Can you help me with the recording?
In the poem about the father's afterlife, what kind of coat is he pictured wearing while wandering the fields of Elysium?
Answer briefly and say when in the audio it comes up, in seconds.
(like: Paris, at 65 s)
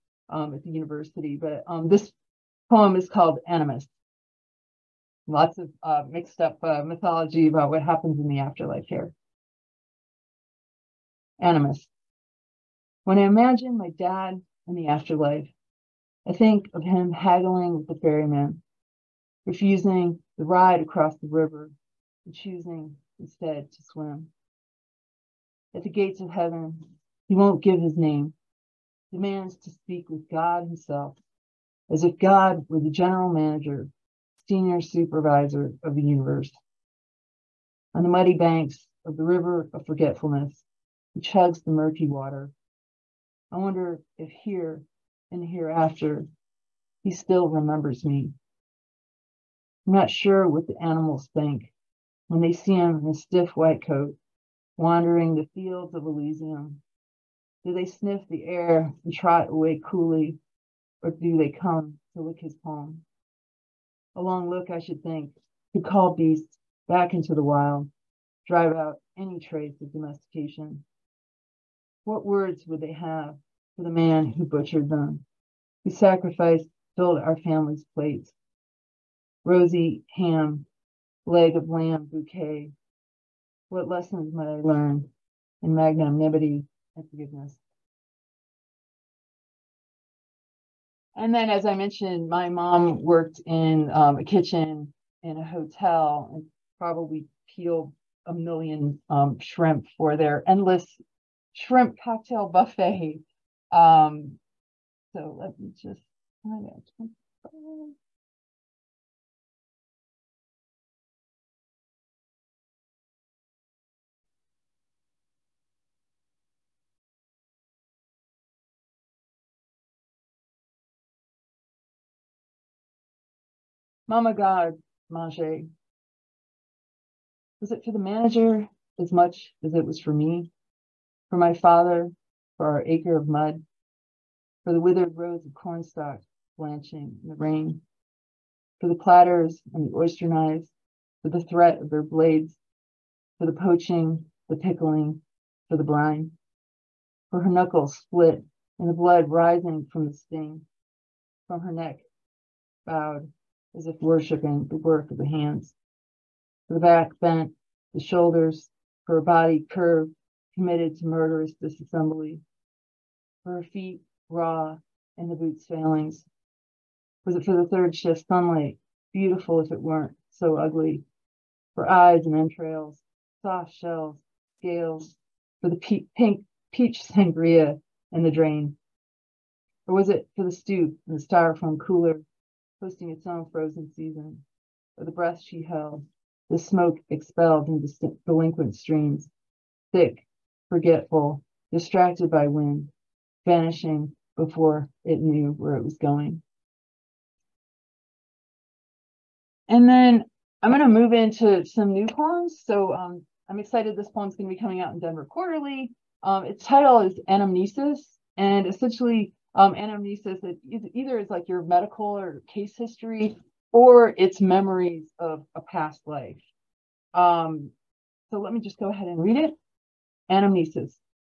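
Stiff white coat, at 53 s.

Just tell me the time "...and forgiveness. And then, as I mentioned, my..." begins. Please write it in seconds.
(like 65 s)
86 s.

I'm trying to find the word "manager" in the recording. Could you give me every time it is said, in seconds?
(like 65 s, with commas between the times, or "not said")
33 s, 127 s.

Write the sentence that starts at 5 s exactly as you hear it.
Lots of uh, mixed up uh, mythology about what happens in the afterlife here.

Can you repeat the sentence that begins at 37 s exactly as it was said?
On the muddy banks of the river of forgetfulness, he chugs the murky water.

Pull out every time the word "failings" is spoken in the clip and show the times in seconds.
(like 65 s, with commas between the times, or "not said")
165 s.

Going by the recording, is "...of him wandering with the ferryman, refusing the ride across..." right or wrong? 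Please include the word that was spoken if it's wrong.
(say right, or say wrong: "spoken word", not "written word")
wrong: "haggling", not "wandering".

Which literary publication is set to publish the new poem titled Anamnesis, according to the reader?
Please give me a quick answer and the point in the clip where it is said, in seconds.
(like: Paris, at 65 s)
Denver Quarterly, at 204 s.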